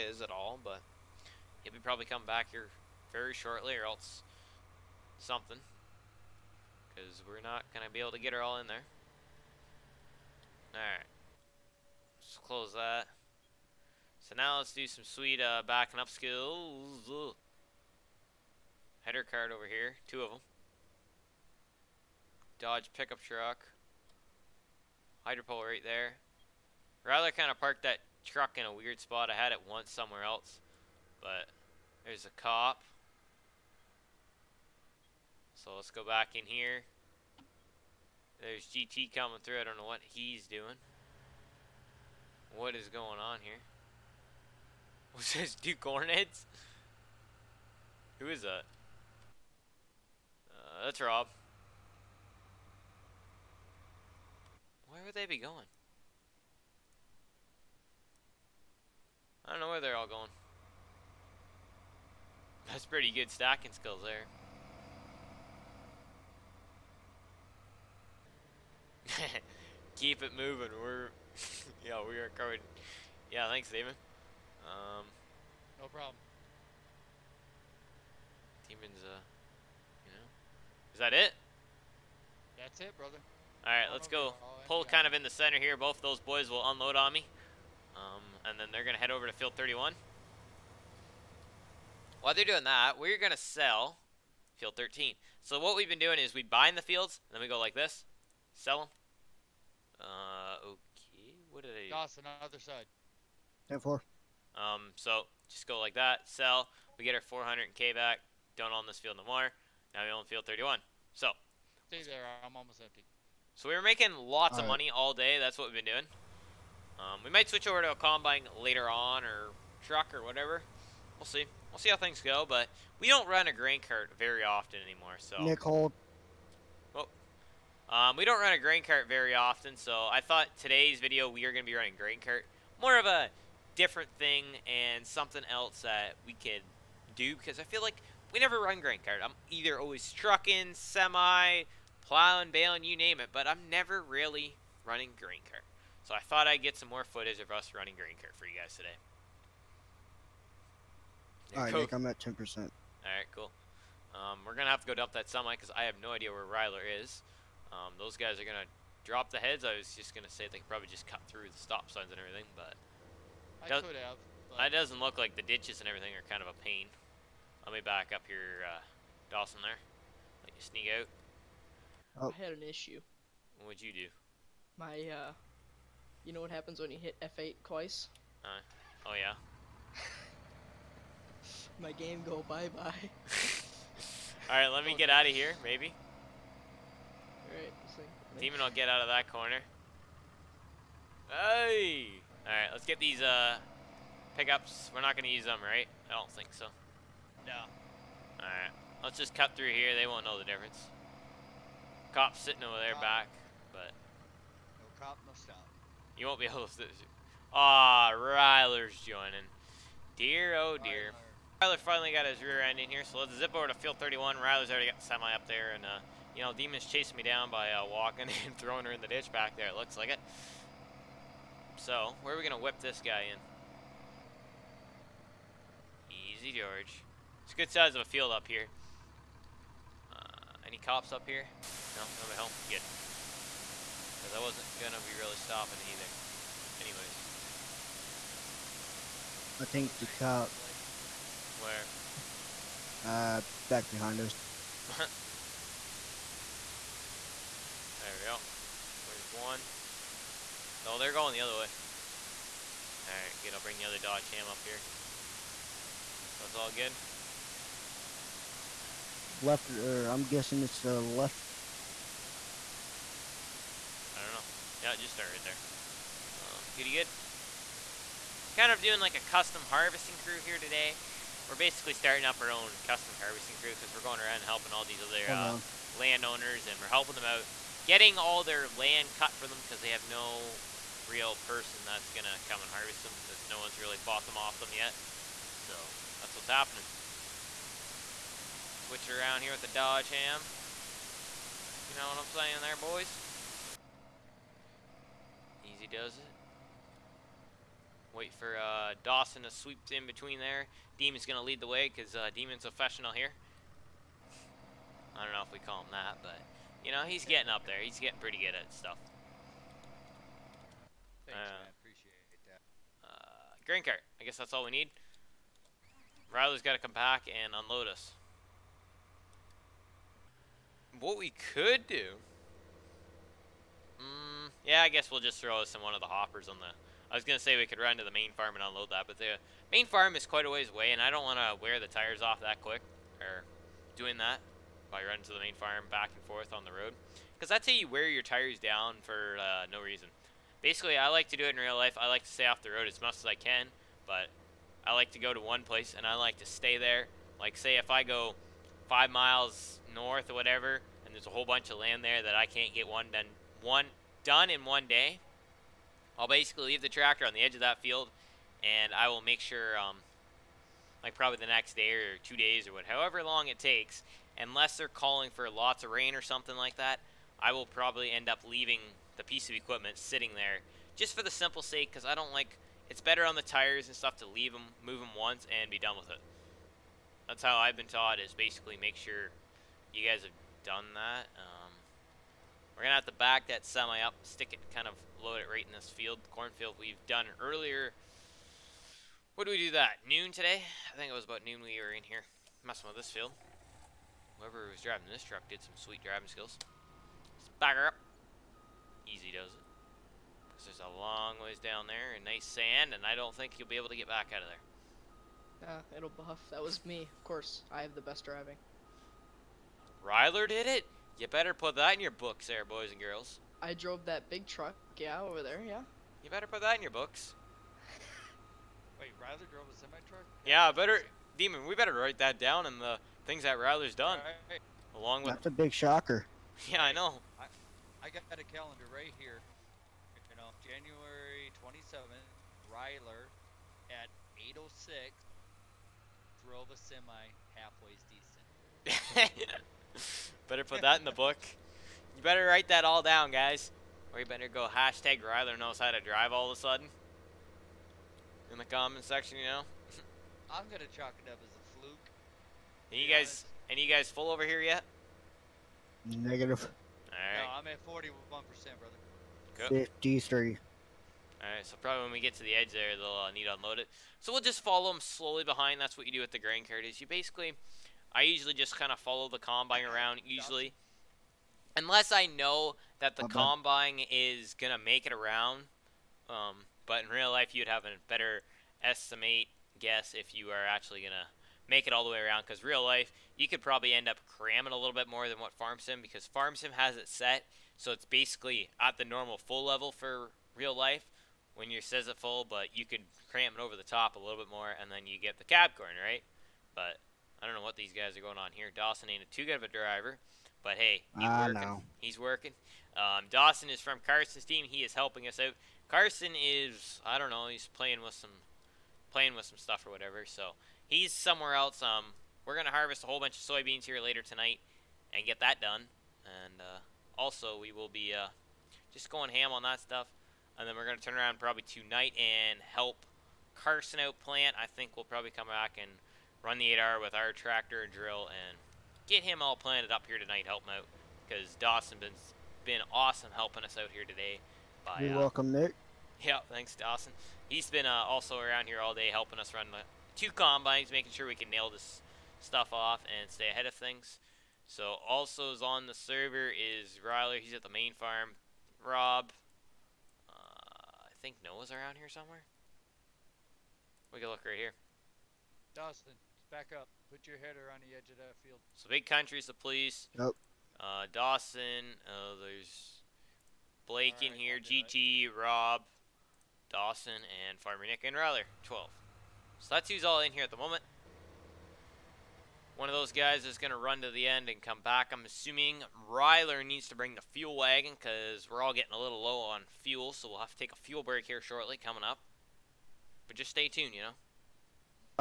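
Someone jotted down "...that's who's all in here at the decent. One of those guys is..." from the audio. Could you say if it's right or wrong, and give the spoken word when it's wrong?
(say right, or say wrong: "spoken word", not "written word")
wrong: "moment", not "decent".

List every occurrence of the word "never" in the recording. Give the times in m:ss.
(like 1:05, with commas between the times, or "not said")
2:18, 2:23.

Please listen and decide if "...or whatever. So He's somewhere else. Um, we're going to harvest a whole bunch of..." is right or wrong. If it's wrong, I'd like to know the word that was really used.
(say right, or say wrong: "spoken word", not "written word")
right.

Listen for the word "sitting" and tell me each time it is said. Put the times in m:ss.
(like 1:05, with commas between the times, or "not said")
3:22, 6:09.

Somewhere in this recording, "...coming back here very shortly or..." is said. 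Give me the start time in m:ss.
0:02.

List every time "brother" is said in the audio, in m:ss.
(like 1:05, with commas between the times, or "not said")
1:22, 7:38.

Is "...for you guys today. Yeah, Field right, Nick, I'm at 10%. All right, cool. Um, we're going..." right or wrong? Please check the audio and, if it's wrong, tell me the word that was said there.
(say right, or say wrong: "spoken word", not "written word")
wrong: "All", not "Field".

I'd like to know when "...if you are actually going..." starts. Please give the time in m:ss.
8:00.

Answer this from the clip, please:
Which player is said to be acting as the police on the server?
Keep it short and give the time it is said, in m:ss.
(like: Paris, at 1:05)
Big Country, at 9:18.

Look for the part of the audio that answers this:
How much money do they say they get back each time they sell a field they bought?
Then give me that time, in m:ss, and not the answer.
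1:46.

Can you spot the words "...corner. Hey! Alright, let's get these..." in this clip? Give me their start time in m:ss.
3:09.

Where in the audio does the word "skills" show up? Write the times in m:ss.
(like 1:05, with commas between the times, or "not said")
0:16, 1:03, 6:36.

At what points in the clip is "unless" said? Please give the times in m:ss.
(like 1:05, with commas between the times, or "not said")
6:04, 7:51.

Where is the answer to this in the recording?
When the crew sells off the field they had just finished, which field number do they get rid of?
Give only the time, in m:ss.
1:32.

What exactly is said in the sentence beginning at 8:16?
But I don't know what these guys are going on here.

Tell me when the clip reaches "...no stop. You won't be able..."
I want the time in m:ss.
3:25.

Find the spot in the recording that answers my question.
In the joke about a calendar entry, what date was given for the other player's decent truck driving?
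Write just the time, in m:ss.
7:10.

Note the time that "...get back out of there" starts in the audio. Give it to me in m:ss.
6:43.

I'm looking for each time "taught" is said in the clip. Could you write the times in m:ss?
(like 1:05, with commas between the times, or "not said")
6:17.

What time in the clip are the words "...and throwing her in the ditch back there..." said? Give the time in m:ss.
3:38.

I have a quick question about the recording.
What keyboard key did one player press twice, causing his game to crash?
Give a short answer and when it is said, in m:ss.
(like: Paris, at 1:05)
F8, at 2:57.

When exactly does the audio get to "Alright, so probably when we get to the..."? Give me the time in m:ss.
7:41.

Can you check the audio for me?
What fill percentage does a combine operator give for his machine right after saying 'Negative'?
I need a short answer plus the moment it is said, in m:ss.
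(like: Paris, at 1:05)
41%, at 7:37.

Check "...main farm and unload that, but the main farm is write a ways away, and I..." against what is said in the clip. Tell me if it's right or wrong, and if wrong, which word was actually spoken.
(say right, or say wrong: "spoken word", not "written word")
wrong: "quite", not "write".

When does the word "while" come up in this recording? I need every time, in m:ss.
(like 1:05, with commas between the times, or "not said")
1:32, 5:34.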